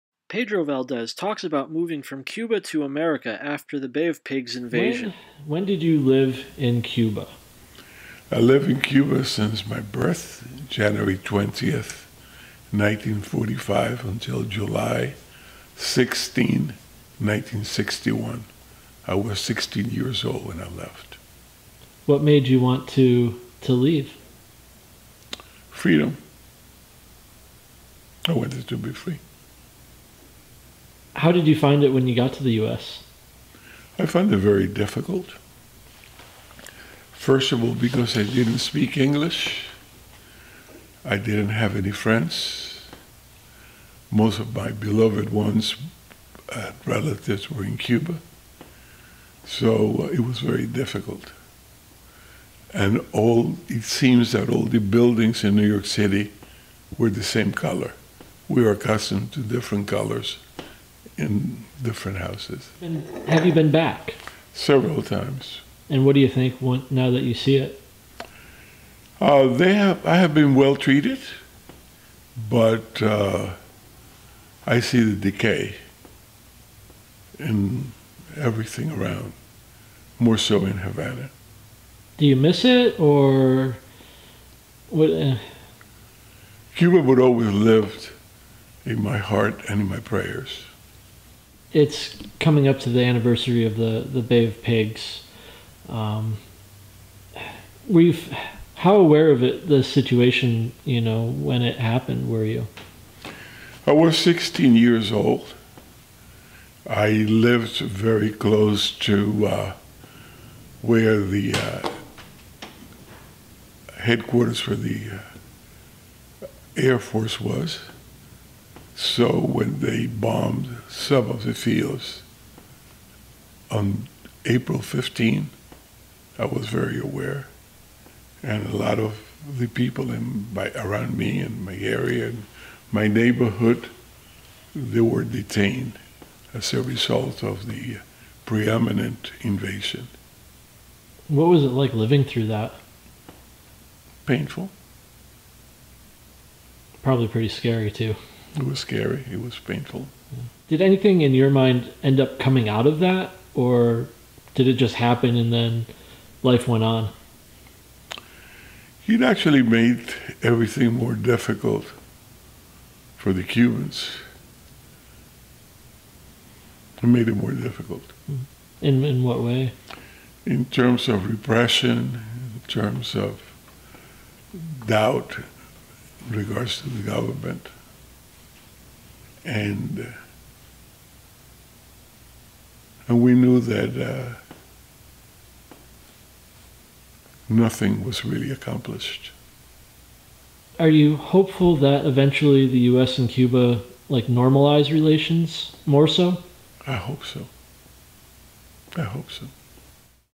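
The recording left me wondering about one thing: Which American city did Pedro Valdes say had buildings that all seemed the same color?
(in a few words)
New York City.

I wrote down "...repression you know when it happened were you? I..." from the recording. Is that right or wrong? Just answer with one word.
wrong.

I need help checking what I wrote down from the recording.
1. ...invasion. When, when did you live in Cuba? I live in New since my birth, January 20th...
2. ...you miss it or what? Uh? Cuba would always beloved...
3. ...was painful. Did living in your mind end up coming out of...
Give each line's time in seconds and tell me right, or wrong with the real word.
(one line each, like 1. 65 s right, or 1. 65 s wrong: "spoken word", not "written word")
1. 4 s wrong: "Cuba", not "New"
2. 82 s wrong: "lived", not "beloved"
3. 149 s wrong: "anything", not "living".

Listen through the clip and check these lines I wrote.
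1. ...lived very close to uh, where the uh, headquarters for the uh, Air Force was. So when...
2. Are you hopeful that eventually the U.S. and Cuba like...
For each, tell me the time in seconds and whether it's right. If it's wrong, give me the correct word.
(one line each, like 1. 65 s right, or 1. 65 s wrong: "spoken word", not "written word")
1. 107 s right
2. 190 s right.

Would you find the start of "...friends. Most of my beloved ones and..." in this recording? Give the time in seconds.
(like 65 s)
41 s.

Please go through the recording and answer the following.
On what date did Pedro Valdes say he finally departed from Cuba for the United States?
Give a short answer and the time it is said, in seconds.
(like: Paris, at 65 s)
July 16, 1961, at 14 s.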